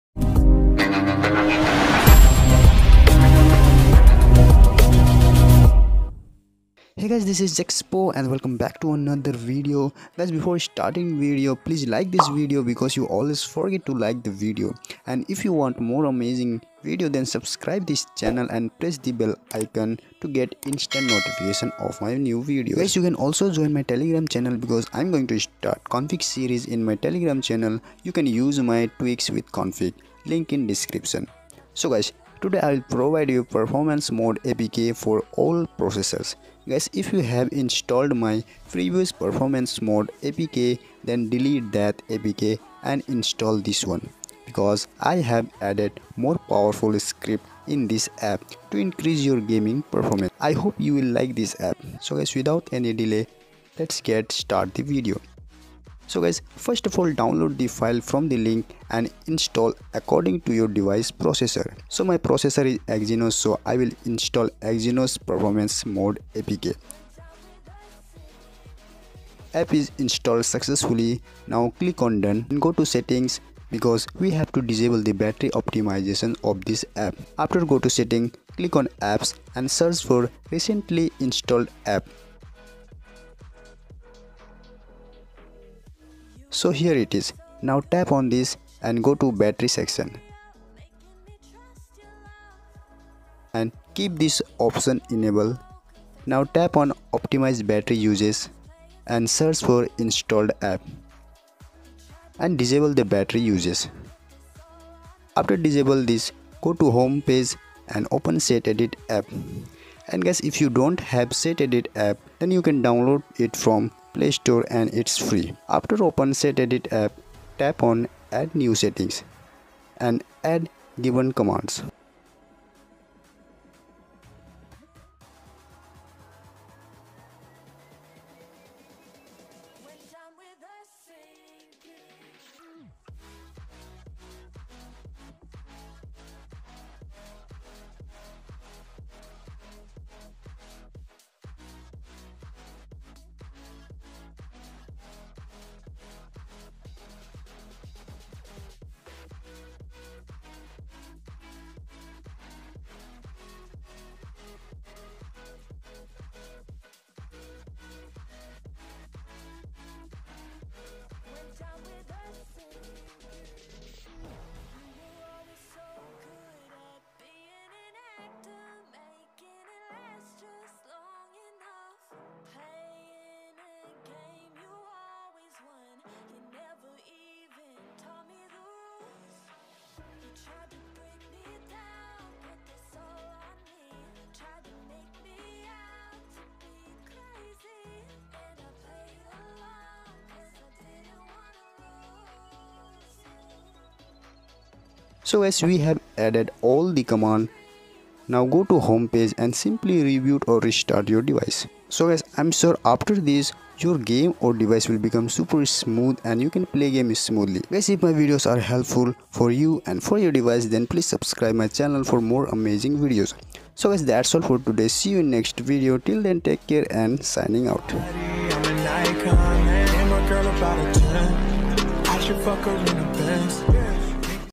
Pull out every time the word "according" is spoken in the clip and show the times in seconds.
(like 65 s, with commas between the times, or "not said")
59 s.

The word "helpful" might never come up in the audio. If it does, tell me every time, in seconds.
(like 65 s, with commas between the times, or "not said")
208 s.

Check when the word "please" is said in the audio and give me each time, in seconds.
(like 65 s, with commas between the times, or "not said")
11 s, 210 s.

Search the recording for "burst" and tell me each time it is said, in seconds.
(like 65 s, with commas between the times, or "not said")
not said.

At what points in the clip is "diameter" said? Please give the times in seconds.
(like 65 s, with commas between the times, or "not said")
not said.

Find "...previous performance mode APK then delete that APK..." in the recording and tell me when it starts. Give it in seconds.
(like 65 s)
38 s.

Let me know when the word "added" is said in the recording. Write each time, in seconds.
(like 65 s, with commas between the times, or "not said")
45 s.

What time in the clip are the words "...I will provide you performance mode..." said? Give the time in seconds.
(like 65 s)
32 s.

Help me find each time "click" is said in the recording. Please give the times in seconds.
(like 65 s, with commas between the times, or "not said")
71 s, 78 s.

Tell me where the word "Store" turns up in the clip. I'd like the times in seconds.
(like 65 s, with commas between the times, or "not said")
114 s.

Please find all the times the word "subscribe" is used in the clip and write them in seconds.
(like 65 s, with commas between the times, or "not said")
17 s, 211 s.